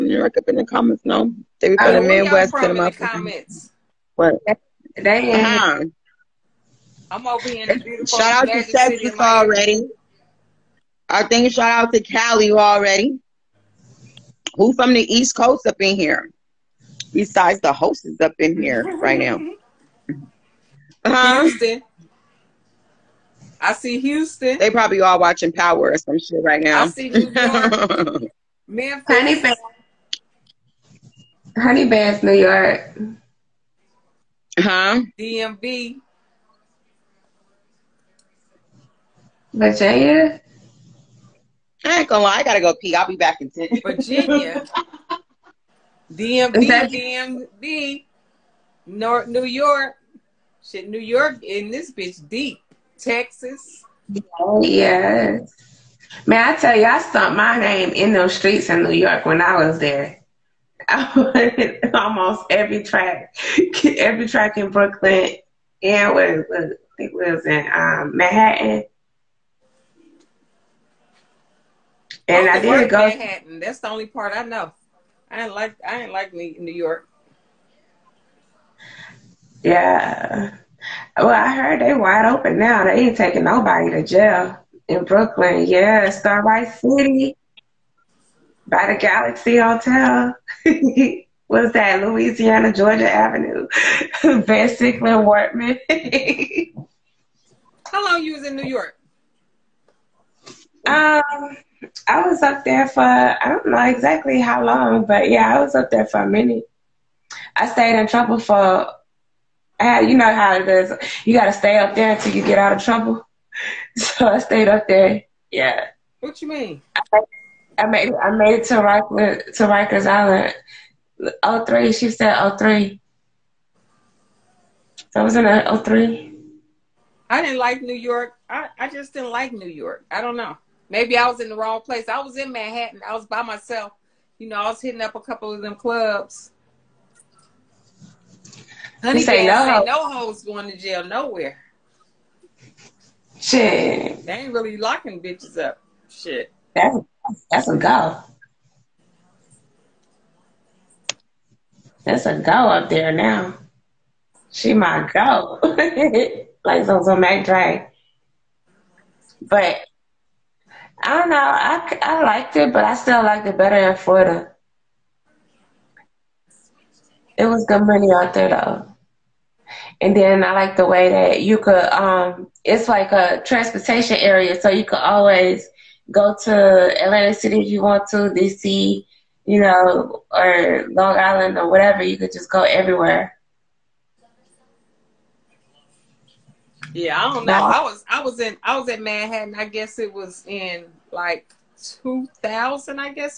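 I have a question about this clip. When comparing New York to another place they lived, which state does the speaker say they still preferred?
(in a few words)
Florida.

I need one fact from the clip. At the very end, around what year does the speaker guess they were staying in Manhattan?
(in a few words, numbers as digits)
2000.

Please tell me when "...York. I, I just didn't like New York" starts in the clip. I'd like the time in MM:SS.
02:07.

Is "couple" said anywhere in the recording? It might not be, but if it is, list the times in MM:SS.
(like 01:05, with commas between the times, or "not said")
02:15.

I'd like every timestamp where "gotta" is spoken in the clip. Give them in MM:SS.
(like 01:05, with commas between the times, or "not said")
00:42.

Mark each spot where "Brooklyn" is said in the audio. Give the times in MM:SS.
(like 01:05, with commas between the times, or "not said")
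01:04, 01:25.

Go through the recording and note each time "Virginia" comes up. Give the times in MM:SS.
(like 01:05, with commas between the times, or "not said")
00:39, 00:43.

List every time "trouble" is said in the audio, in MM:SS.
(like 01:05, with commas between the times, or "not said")
01:48, 01:52.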